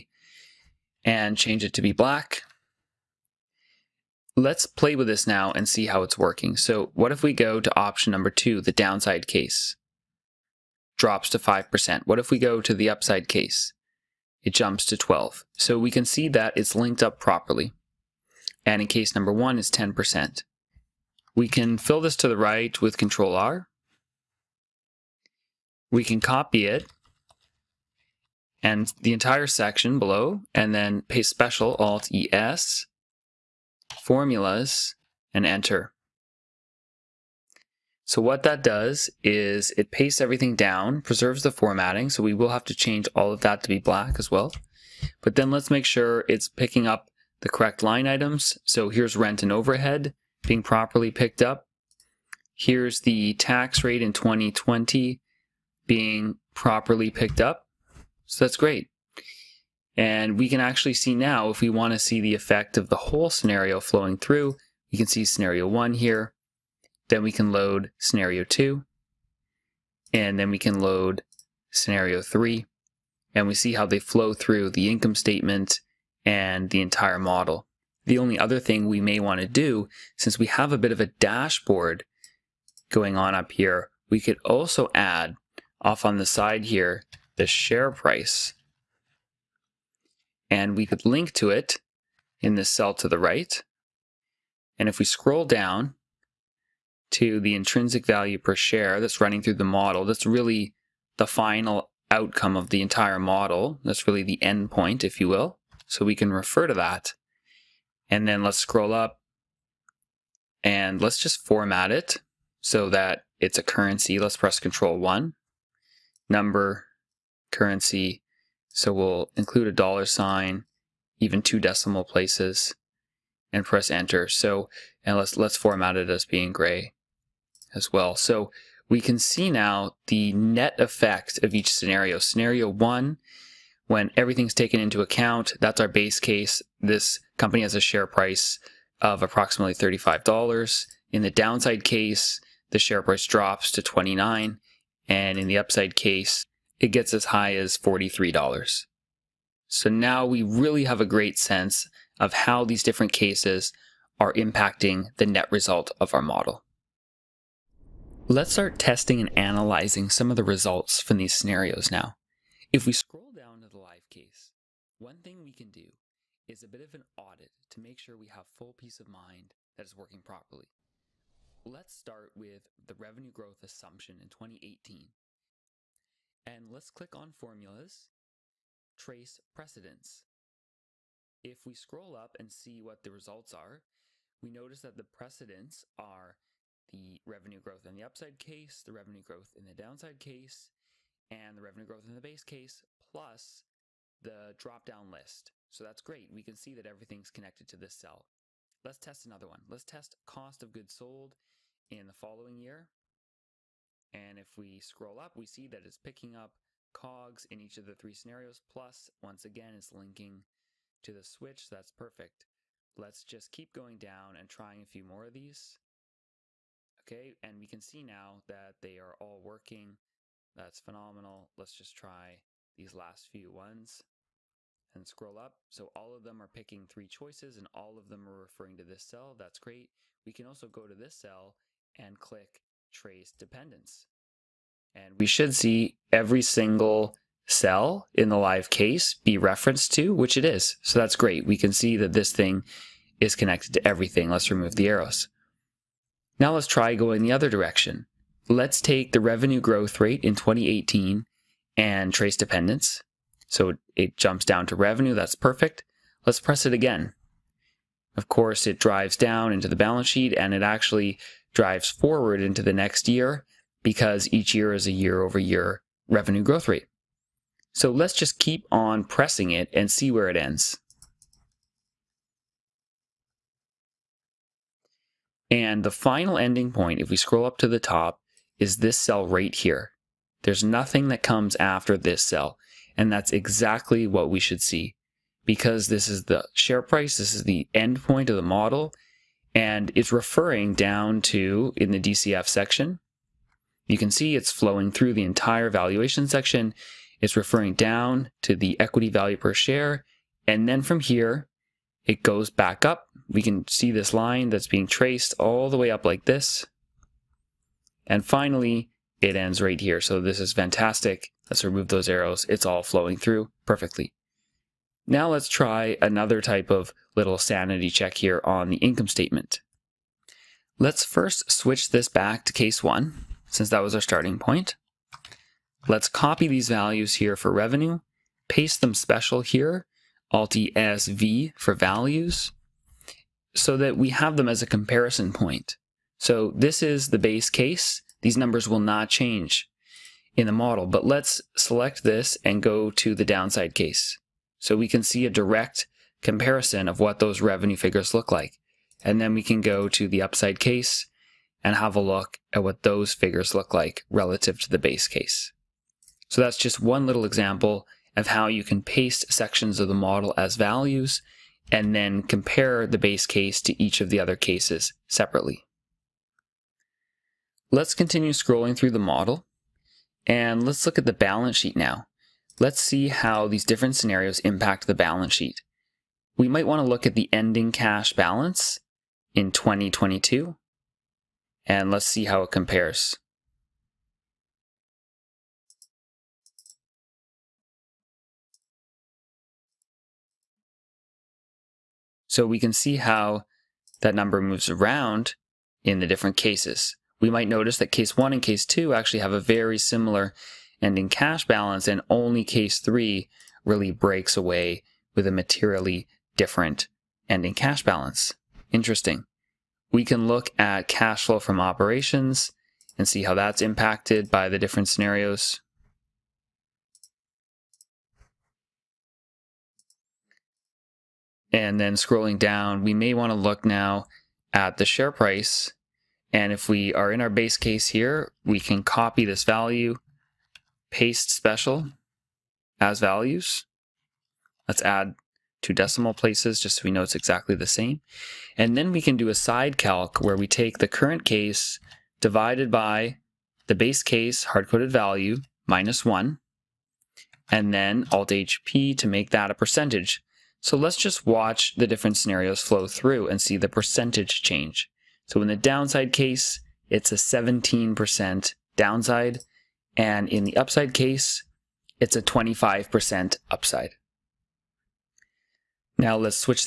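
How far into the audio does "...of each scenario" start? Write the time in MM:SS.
02:11.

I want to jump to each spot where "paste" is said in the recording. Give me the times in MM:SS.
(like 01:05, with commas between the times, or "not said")
00:31, 00:39, 05:28, 05:58, 07:10.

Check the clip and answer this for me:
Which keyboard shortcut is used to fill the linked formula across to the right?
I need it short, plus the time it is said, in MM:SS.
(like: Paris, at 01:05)
Control R, at 00:22.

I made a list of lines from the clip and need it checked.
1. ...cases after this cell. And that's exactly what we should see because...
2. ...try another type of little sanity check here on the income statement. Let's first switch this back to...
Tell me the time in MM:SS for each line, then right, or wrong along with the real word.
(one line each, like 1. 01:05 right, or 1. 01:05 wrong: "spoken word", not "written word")
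1. 04:41 wrong: "comes", not "cases"
2. 05:15 right.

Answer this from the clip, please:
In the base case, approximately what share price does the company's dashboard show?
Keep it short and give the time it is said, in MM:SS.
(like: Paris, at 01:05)
$35, at 02:19.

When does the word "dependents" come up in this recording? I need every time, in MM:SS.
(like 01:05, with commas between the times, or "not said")
03:53, 04:12.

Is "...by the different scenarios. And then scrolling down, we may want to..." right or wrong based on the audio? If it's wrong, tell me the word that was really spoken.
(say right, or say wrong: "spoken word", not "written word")
right.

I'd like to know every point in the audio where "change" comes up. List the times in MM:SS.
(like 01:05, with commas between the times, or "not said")
00:01, 00:42, 05:39, 07:34.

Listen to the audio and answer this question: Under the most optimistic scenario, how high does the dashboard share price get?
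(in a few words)
$43.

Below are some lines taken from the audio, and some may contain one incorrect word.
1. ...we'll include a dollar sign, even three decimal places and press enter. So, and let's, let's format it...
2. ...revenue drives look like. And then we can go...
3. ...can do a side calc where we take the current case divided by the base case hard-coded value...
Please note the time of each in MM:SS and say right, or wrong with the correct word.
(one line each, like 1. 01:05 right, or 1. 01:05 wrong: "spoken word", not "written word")
1. 01:58 wrong: "two", not "three"
2. 05:47 wrong: "figures", not "drives"
3. 07:19 right.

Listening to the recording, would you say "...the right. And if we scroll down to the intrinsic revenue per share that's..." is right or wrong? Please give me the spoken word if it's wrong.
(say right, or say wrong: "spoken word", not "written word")
wrong: "value", not "revenue".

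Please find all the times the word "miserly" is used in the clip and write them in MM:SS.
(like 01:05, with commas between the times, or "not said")
not said.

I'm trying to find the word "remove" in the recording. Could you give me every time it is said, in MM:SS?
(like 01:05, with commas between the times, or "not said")
04:04, 05:11.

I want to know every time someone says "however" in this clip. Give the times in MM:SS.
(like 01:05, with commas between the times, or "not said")
not said.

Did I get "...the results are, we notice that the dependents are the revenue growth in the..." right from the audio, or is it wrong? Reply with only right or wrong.
wrong.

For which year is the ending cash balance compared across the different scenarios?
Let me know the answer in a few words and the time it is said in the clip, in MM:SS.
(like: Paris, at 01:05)
2022, at 06:19.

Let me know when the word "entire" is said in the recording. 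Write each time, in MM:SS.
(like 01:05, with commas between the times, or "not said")
00:29, 01:16, 01:42, 04:55.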